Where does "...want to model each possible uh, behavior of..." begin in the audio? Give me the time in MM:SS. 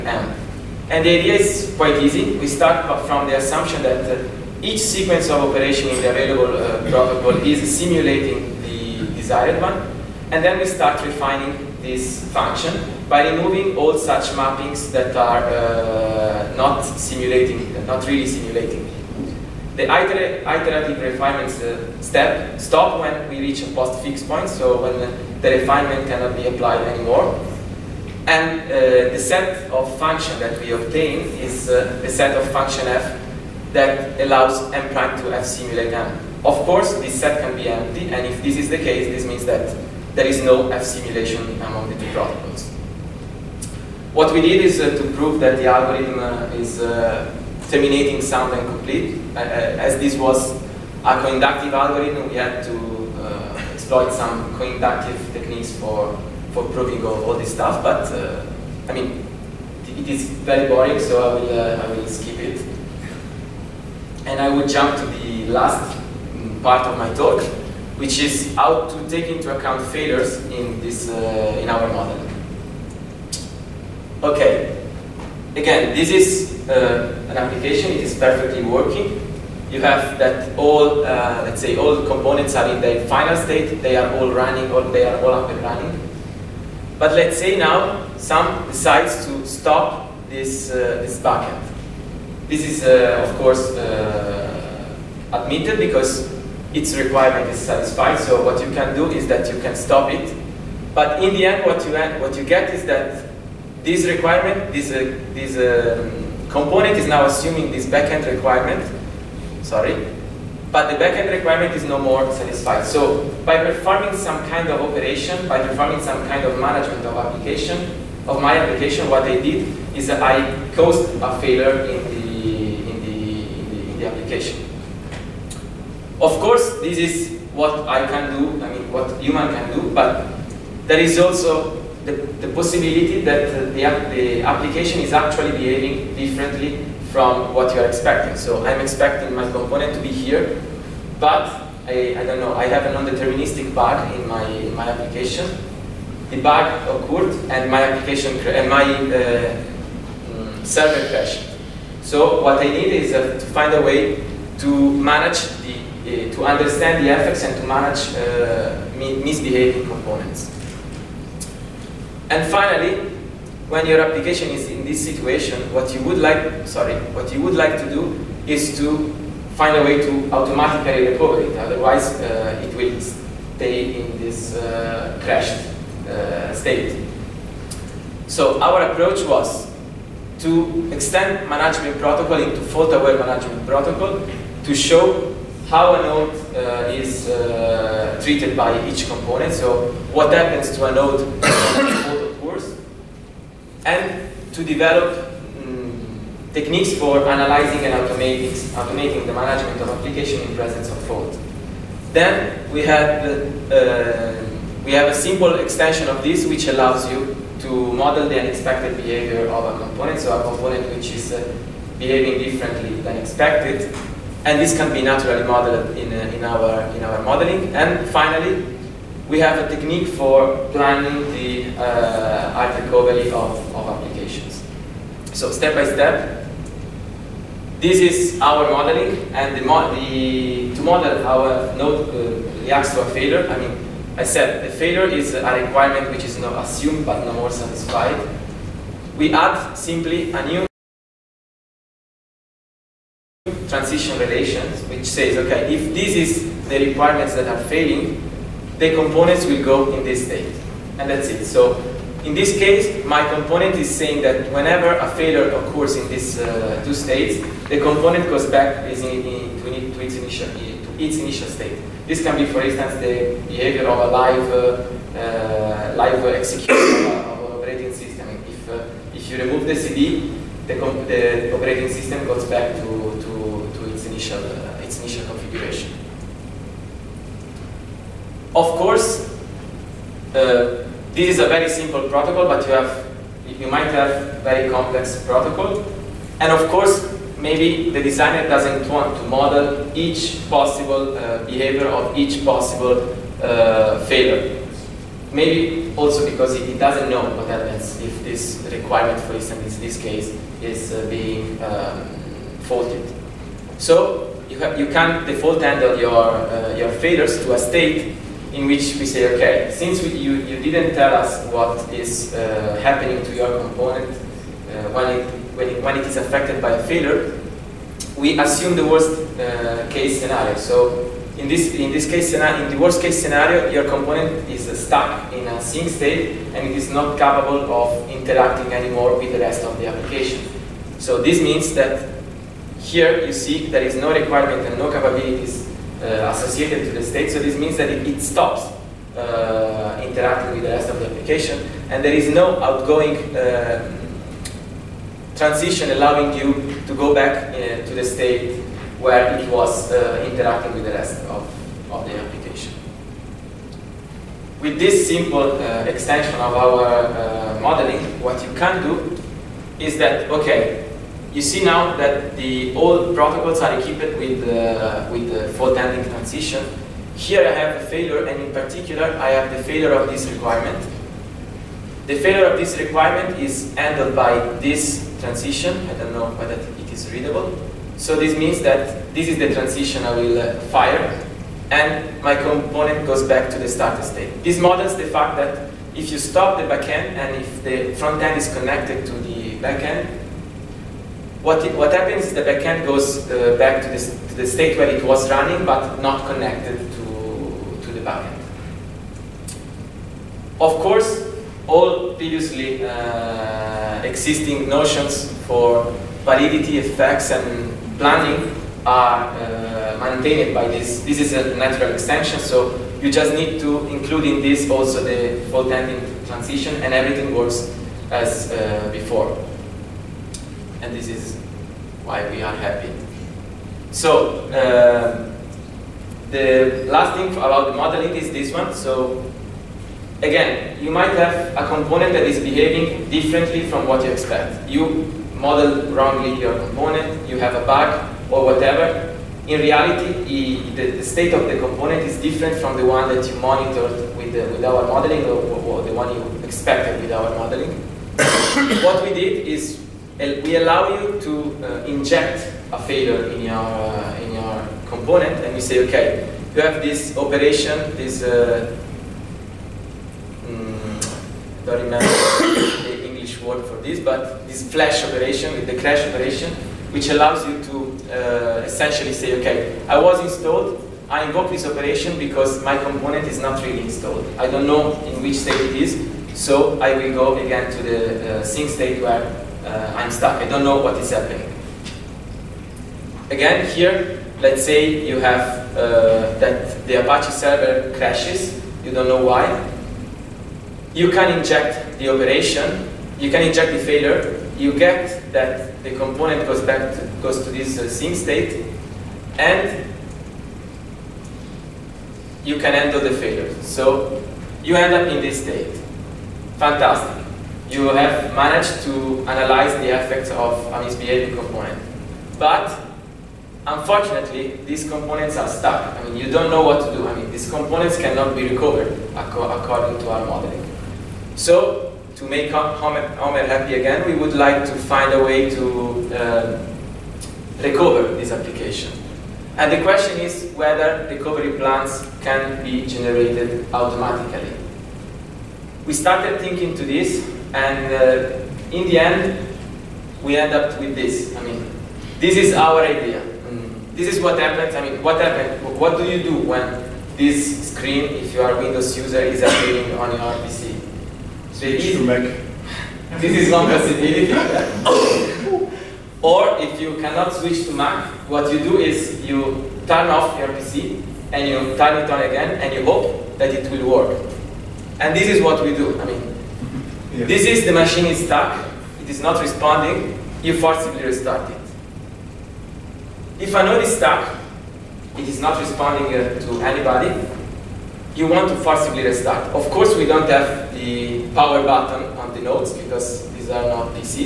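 04:48.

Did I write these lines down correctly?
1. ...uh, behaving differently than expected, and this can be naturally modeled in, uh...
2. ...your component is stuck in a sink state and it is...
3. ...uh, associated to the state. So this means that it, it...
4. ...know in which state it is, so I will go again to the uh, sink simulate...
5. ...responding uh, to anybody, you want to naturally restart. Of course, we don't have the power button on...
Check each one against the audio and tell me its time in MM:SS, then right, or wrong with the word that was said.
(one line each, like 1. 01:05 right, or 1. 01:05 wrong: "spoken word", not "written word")
1. 03:31 right
2. 05:23 right
3. 05:36 right
4. 07:54 wrong: "state", not "simulate"
5. 09:35 wrong: "forcibly", not "naturally".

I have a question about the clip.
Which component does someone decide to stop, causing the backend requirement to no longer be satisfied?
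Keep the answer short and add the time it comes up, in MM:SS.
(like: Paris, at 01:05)
bucket, at 01:31.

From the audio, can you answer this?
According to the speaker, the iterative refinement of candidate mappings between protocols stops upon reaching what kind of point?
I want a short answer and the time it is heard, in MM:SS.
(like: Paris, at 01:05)
post fixed point, at 00:23.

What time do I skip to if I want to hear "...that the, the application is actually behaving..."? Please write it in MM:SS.
02:13.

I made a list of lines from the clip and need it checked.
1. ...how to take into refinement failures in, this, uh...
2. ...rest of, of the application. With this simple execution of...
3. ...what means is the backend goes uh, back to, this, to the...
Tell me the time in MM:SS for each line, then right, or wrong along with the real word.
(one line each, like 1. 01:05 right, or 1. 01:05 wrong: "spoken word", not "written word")
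1. 01:08 wrong: "account", not "refinement"
2. 05:50 wrong: "extension", not "execution"
3. 06:31 wrong: "happens", not "means".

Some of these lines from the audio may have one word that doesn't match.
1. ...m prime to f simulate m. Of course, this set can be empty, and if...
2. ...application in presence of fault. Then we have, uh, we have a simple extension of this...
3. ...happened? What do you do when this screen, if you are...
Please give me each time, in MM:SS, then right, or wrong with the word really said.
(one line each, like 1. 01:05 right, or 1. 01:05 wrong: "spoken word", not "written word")
1. 00:34 right
2. 03:19 right
3. 09:05 right.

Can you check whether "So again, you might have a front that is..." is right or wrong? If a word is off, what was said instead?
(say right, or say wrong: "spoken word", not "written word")
wrong: "component", not "front".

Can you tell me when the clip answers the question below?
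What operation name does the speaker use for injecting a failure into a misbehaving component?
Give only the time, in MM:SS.
07:45.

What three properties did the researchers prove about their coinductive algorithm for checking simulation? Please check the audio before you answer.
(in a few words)
terminating, sound and complete.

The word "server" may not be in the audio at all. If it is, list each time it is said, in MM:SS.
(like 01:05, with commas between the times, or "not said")
02:30, 08:07.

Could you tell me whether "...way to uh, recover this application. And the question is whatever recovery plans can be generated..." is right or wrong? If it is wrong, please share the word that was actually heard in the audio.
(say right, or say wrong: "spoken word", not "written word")
wrong: "whether", not "whatever".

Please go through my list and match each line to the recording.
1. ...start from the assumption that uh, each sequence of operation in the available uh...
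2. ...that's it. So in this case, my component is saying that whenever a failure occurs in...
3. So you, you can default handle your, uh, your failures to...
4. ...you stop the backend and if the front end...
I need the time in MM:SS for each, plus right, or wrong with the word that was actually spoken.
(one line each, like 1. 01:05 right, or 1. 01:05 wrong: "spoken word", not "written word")
1. 00:02 right
2. 04:11 right
3. 05:03 right
4. 06:26 right.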